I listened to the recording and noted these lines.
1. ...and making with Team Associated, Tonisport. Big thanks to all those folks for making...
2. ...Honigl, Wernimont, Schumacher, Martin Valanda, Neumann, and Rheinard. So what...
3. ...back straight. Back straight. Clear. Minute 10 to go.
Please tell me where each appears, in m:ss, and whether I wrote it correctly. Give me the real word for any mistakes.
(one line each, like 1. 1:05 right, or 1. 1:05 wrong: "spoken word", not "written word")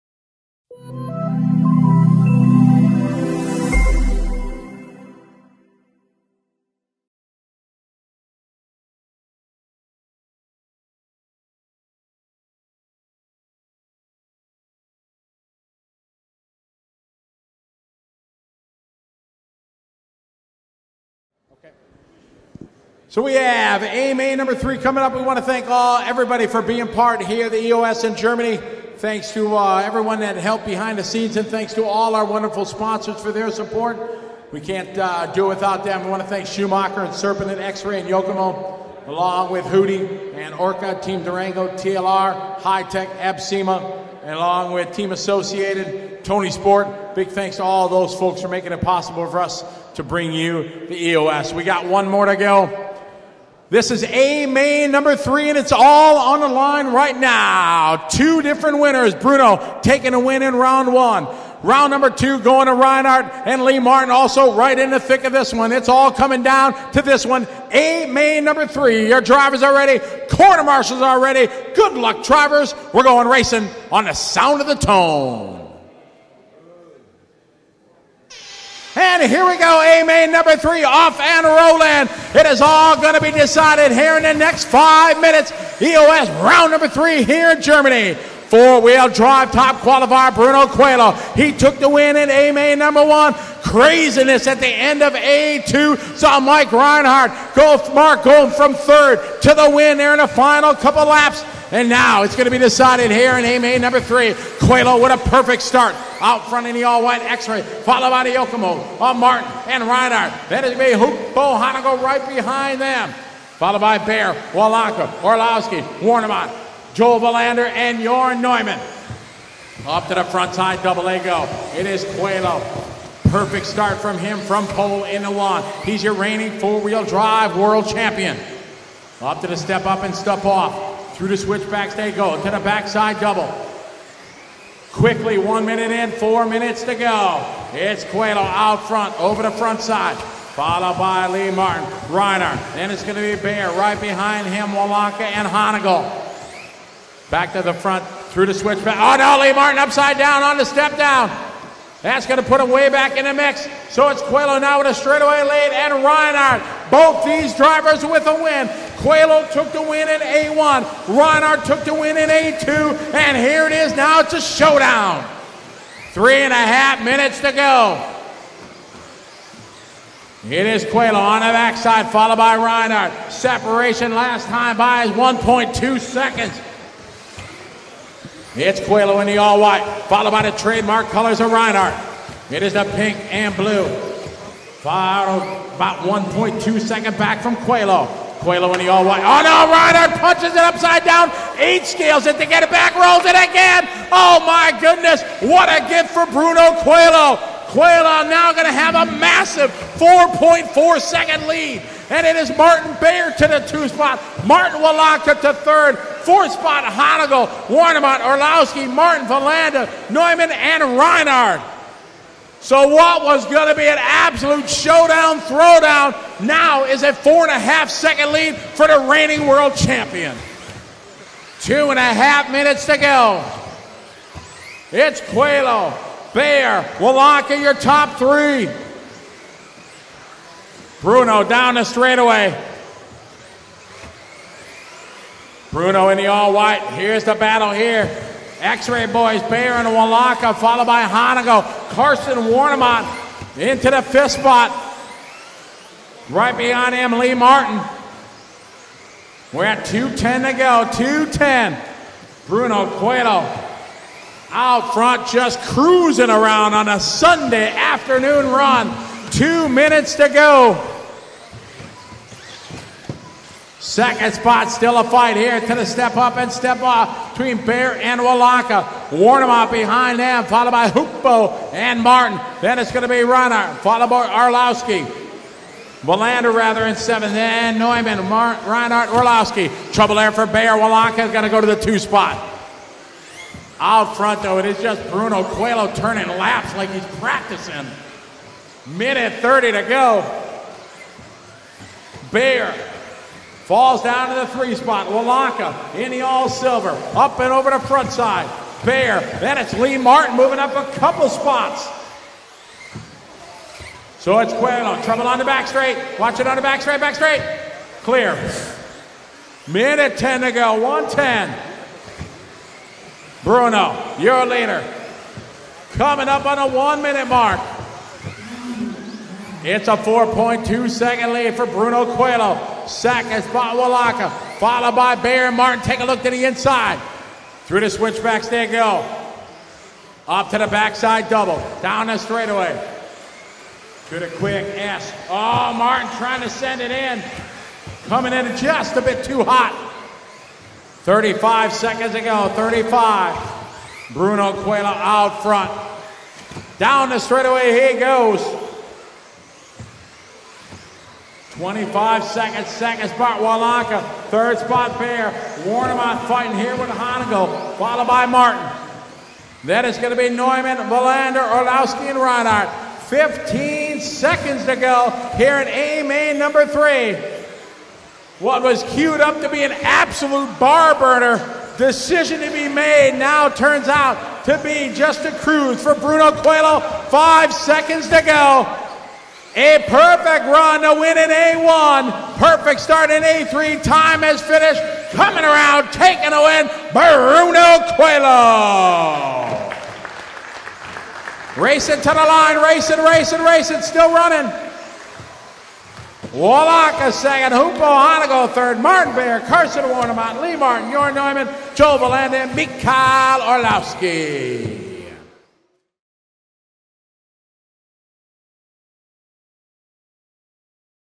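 1. 0:44 wrong: "along", not "making"
2. 3:26 wrong: "Orlowski", not "Schumacher"
3. 5:06 right.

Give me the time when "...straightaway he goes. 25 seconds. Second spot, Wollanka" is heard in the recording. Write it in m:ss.
5:47.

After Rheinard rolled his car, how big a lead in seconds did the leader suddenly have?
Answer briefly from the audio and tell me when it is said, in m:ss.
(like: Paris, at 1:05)
4.4 seconds, at 3:19.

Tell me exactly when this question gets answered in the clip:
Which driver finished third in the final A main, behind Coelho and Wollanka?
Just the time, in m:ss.
6:37.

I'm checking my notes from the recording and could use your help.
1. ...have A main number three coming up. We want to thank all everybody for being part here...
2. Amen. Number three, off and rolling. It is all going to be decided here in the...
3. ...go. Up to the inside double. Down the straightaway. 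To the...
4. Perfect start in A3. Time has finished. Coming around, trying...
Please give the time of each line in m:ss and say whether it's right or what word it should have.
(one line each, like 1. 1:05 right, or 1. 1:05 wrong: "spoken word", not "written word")
1. 0:23 right
2. 1:20 right
3. 5:28 wrong: "backside", not "inside"
4. 6:22 wrong: "taking", not "trying".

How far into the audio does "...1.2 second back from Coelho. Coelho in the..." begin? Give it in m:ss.
3:05.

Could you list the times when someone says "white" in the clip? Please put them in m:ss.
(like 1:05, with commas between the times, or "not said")
1:47, 2:59, 3:09, 3:56.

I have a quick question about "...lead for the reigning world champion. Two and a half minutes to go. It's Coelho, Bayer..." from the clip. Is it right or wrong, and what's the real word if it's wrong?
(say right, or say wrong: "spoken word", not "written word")
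right.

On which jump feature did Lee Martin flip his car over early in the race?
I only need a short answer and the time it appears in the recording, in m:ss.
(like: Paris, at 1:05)
The step down, at 2:30.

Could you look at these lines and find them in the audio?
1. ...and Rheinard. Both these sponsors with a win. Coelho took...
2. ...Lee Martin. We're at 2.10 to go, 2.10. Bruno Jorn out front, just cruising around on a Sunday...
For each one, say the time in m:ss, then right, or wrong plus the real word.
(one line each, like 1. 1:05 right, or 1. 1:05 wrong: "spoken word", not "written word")
1. 2:35 wrong: "drivers", not "sponsors"
2. 4:07 wrong: "Coelho", not "Jorn".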